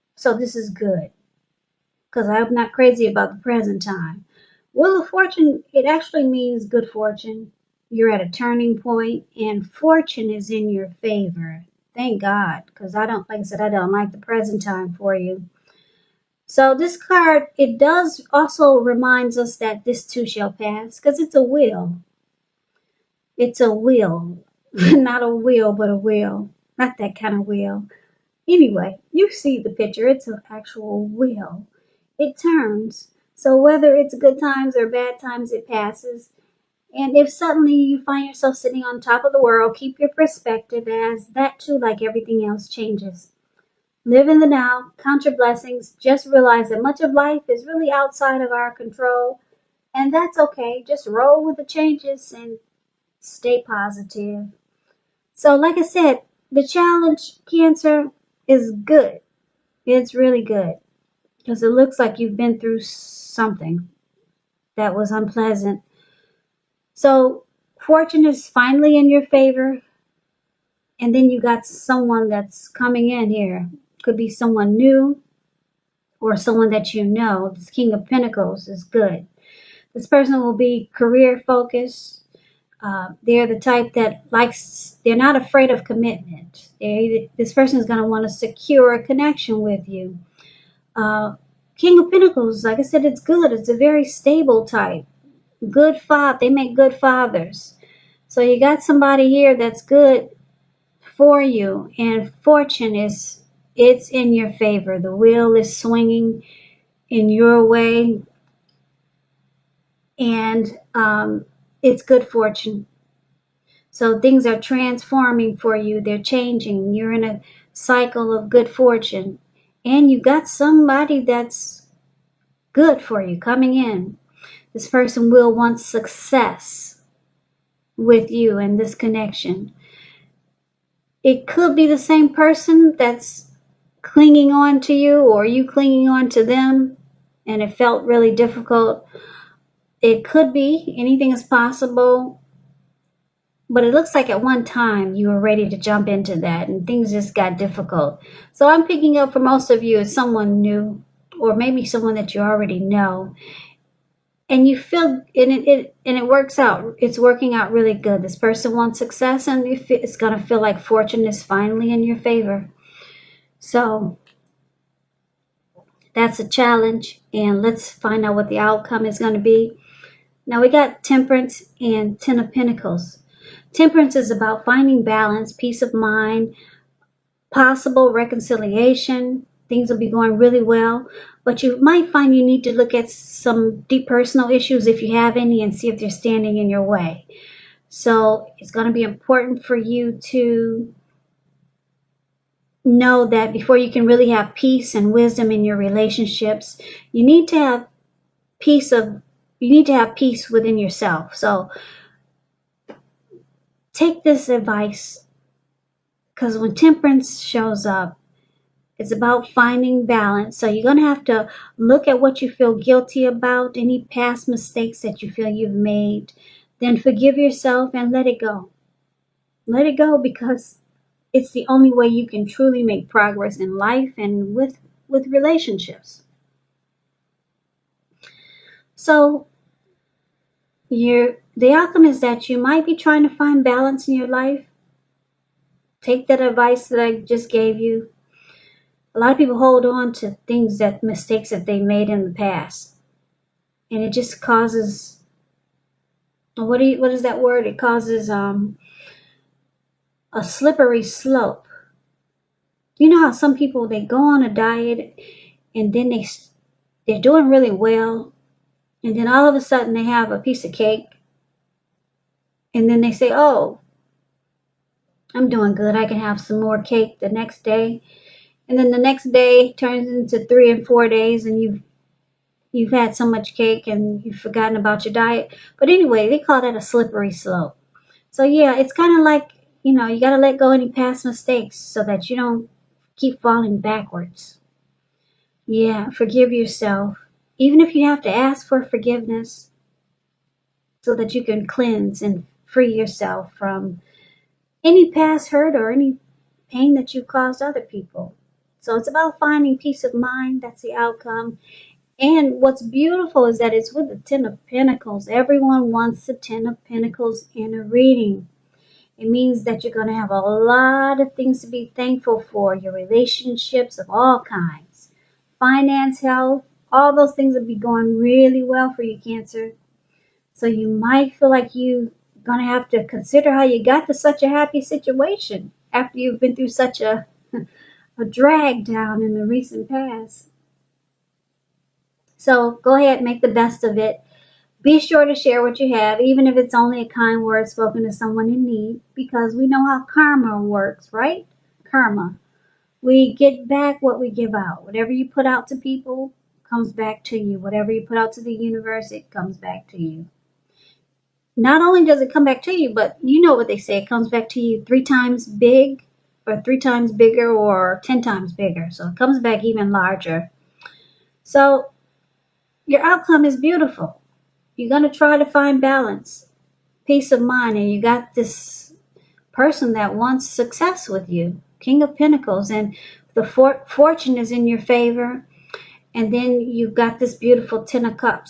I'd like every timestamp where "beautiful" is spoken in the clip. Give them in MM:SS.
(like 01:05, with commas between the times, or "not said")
05:02, 06:03, 06:17.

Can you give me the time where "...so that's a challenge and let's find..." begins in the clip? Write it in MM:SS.
02:43.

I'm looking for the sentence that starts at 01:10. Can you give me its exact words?
And then you got someone that's coming in here.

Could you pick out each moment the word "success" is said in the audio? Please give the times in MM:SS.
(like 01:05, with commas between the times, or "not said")
02:05, 02:38, 06:10.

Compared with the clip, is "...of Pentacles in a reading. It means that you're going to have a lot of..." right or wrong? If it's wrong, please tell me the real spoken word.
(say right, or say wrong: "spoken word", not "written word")
right.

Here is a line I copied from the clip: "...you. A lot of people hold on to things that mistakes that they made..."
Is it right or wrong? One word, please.
right.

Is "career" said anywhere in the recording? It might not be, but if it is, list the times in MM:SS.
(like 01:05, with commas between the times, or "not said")
01:20.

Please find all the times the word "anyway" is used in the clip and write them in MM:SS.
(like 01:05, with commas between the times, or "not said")
00:28, 04:35.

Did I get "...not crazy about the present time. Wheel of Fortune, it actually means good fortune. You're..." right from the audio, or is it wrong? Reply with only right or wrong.
right.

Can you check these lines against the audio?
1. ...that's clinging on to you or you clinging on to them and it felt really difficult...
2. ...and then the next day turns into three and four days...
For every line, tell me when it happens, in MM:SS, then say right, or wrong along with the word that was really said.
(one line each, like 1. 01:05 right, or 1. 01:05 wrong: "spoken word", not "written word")
1. 02:12 right
2. 04:28 right.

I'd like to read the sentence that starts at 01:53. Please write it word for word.
So things are transforming for you, they're changing.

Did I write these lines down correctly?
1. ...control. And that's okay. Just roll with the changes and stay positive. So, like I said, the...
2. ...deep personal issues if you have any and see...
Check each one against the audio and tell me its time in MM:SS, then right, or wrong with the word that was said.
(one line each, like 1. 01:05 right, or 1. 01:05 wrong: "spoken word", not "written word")
1. 00:48 right
2. 03:03 right.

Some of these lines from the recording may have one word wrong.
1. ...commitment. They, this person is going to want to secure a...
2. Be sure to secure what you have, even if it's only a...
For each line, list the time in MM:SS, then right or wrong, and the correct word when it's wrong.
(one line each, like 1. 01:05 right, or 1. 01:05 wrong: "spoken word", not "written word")
1. 01:25 right
2. 05:34 wrong: "share", not "secure".